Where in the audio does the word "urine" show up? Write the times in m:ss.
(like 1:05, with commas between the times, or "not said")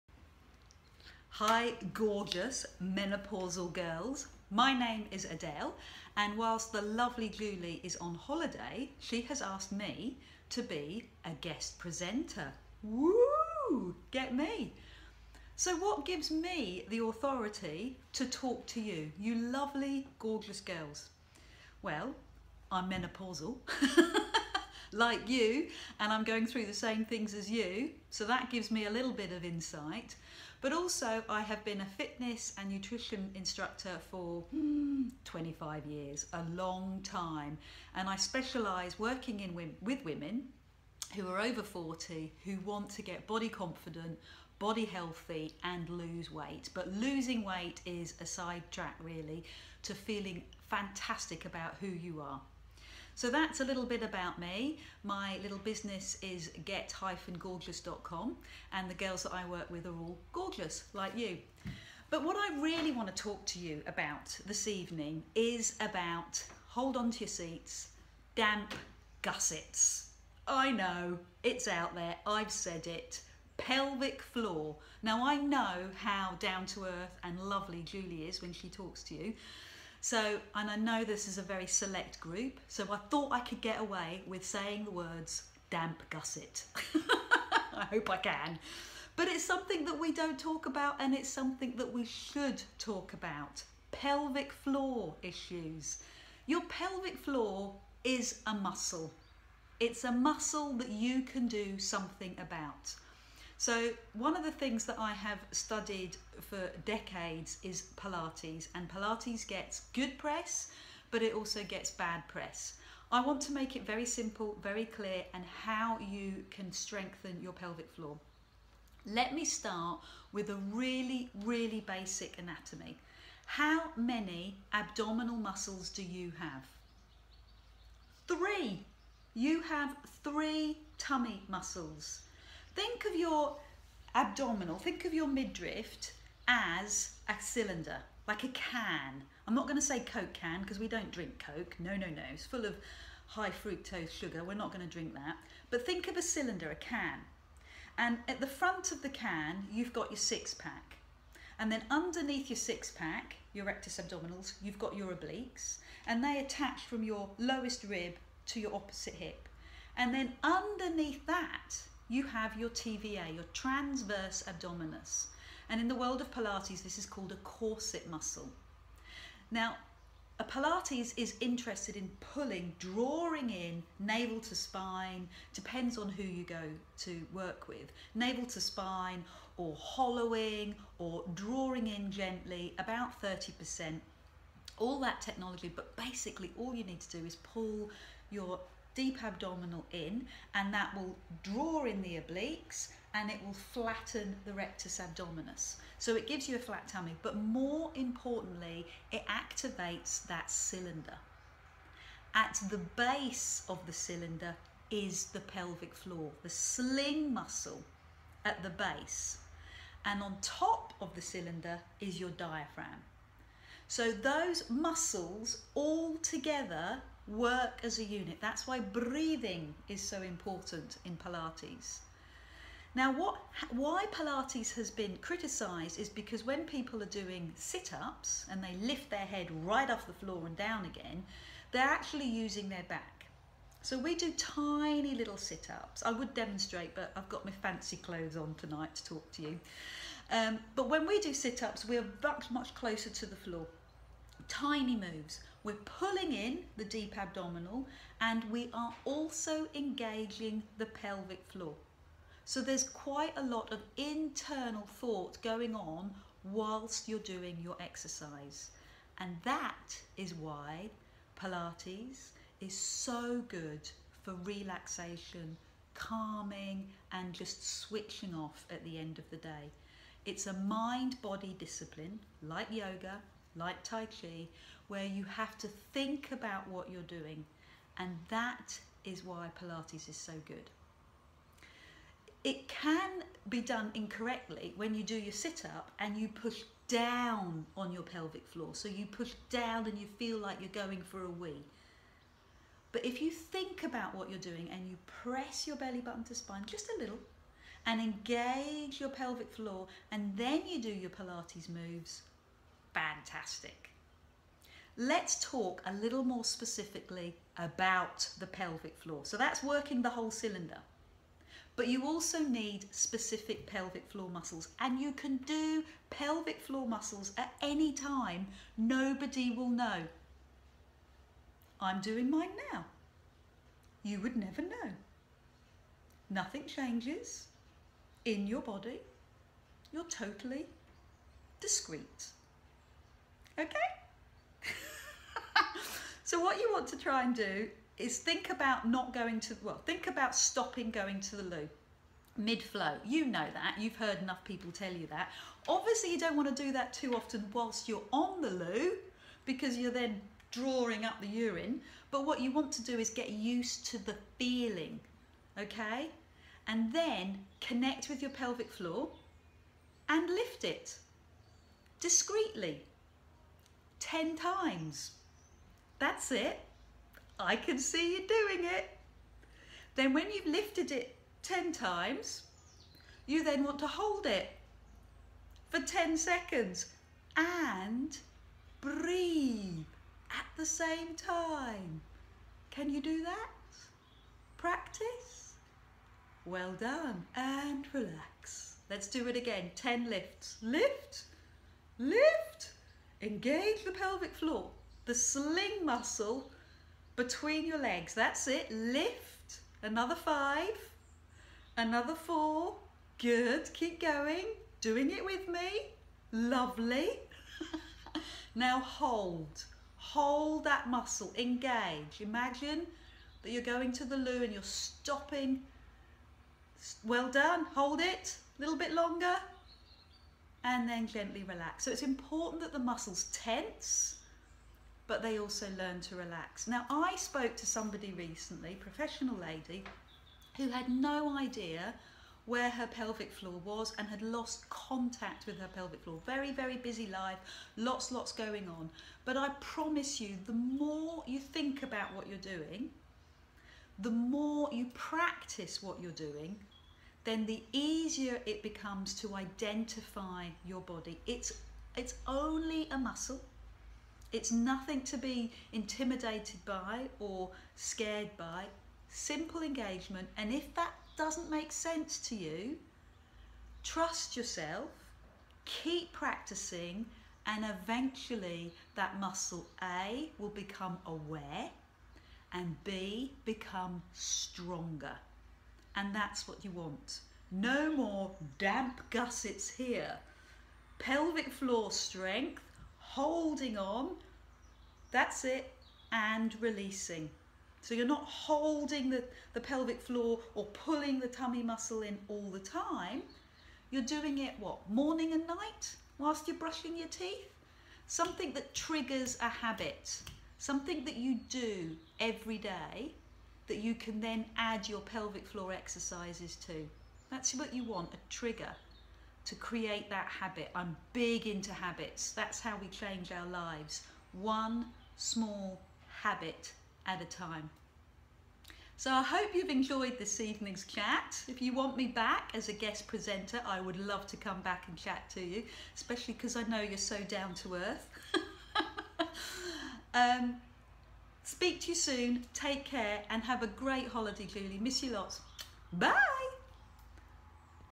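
5:51.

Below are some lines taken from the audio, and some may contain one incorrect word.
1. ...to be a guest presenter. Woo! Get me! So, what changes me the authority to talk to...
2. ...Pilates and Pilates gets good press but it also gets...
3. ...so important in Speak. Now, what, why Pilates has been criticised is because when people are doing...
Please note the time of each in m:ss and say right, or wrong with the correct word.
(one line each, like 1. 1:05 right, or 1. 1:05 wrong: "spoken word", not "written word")
1. 0:10 wrong: "gives", not "changes"
2. 1:47 right
3. 3:40 wrong: "Pilates", not "Speak".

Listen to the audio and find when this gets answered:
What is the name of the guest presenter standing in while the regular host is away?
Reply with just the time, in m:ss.
0:05.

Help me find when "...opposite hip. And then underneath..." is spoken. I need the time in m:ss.
2:38.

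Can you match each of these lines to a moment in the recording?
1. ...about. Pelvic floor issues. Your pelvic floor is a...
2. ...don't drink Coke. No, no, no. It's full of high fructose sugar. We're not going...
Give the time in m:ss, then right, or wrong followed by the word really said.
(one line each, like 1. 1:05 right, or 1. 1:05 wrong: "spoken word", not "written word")
1. 1:33 right
2. 2:20 right.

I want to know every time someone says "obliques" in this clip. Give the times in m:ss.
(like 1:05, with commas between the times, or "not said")
2:35, 3:12.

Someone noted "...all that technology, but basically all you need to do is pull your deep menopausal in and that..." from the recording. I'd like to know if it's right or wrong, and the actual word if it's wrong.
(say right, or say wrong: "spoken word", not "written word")
wrong: "abdominal", not "menopausal".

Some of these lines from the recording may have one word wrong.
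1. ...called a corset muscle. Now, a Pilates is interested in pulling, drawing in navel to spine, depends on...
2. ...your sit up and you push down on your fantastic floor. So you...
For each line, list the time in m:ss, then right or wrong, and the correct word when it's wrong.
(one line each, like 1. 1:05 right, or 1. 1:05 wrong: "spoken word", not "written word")
1. 2:47 right
2. 4:45 wrong: "pelvic", not "fantastic".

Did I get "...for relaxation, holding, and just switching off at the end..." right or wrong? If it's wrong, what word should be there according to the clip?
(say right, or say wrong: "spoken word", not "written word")
wrong: "calming", not "holding".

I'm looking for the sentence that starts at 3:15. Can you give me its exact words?
So it gives you a flat tummy, but more importantly, it activates that cylinder.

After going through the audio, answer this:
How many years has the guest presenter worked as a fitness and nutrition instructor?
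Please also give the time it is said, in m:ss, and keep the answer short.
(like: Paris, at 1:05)
25, at 0:35.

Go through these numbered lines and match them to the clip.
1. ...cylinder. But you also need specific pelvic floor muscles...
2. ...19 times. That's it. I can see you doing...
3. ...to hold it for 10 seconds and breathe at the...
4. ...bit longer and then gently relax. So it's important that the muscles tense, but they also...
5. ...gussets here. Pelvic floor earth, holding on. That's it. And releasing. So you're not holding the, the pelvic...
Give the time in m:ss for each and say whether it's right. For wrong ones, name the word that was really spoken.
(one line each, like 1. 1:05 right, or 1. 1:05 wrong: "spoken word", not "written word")
1. 5:10 right
2. 6:04 wrong: "10", not "19"
3. 6:13 right
4. 6:58 right
5. 7:59 wrong: "strength", not "earth".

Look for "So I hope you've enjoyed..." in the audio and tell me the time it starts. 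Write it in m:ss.
8:38.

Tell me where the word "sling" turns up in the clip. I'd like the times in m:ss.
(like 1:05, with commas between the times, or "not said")
3:26, 6:35.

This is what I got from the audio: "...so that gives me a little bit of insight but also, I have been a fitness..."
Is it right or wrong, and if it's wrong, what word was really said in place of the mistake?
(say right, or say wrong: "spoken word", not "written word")
right.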